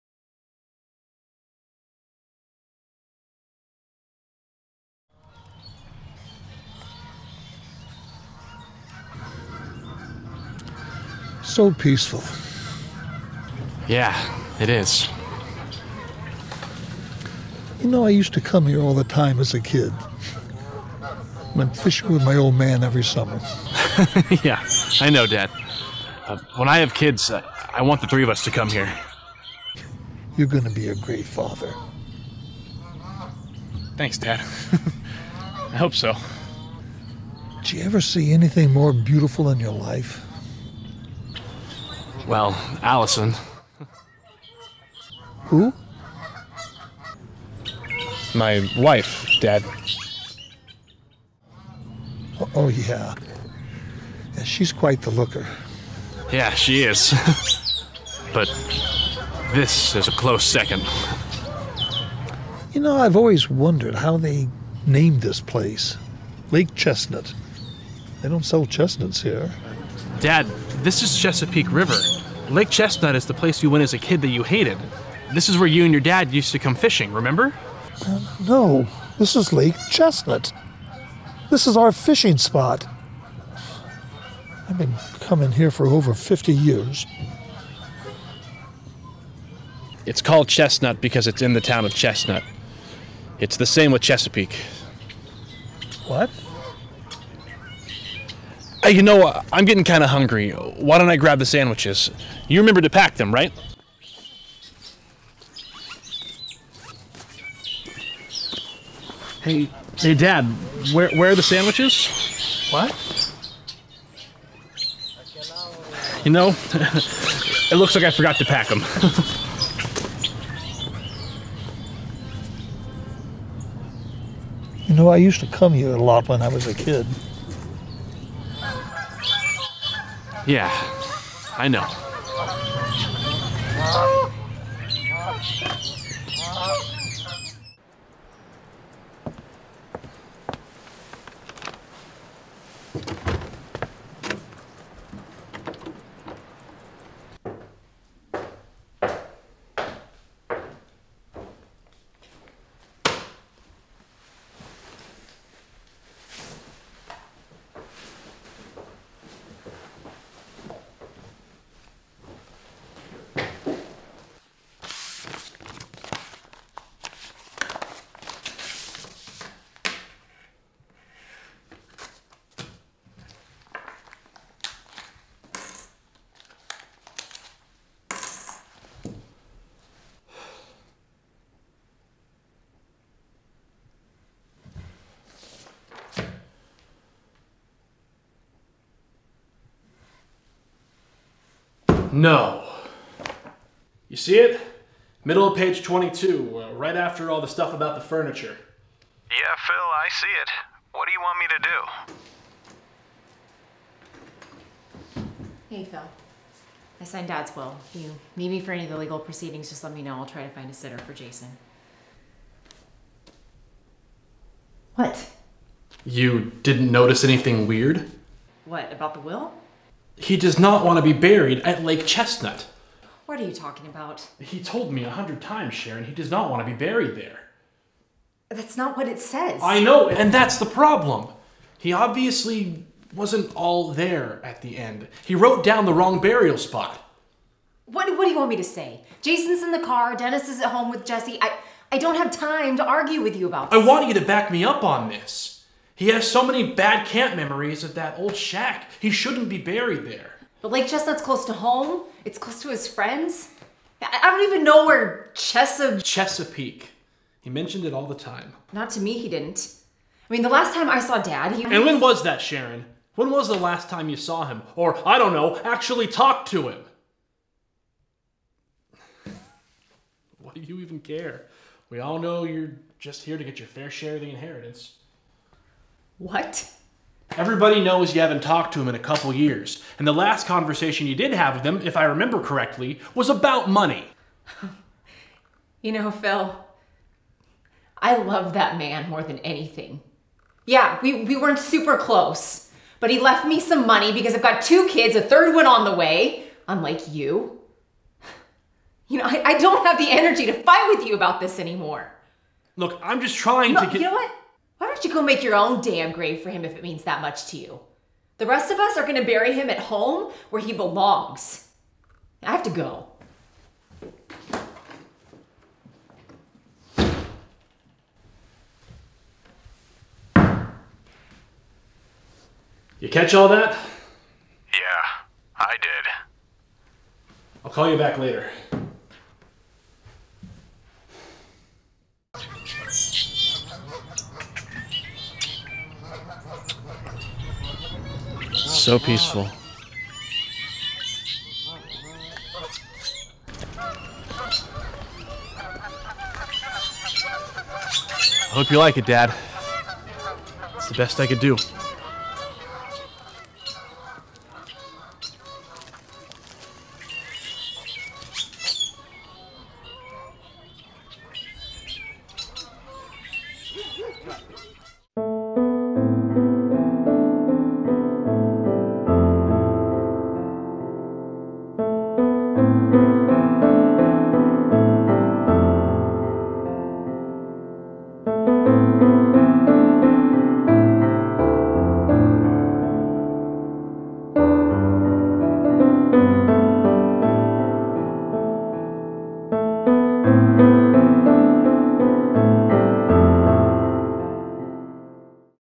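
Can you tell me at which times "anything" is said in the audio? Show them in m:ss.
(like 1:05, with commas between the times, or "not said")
0:38, 3:37, 4:49.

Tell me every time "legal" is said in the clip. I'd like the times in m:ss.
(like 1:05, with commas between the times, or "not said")
3:28.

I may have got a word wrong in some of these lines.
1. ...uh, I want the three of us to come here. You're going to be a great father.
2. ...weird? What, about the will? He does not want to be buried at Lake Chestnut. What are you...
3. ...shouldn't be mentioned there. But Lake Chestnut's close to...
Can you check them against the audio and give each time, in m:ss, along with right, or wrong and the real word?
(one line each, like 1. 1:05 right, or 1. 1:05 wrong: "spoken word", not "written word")
1. 0:27 right
2. 3:37 right
3. 4:09 wrong: "buried", not "mentioned".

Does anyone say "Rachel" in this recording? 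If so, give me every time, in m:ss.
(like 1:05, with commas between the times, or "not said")
not said.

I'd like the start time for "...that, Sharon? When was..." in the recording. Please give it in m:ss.
4:22.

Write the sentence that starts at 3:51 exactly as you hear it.
He obviously wasn't all there at the end.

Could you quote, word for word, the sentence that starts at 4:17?
He mentioned it all the time.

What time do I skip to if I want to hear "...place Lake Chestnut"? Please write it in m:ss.
1:05.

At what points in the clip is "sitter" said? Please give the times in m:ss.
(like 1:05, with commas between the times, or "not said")
3:30.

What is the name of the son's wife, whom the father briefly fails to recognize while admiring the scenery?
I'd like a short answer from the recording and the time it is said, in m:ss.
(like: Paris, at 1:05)
Allison, at 0:42.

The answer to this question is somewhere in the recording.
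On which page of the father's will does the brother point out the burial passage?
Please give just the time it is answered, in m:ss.
3:15.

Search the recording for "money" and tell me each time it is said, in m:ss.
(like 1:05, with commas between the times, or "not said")
4:43, 4:53.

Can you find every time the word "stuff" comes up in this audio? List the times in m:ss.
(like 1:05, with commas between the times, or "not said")
3:17.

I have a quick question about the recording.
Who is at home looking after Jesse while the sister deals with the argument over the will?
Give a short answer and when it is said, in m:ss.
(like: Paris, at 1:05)
Dennis, at 4:00.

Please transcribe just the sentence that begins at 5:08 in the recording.
The rest of us are gonna bury him at home where he belongs.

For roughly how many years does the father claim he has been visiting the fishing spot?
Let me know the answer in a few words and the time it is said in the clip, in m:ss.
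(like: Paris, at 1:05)
50, at 1:26.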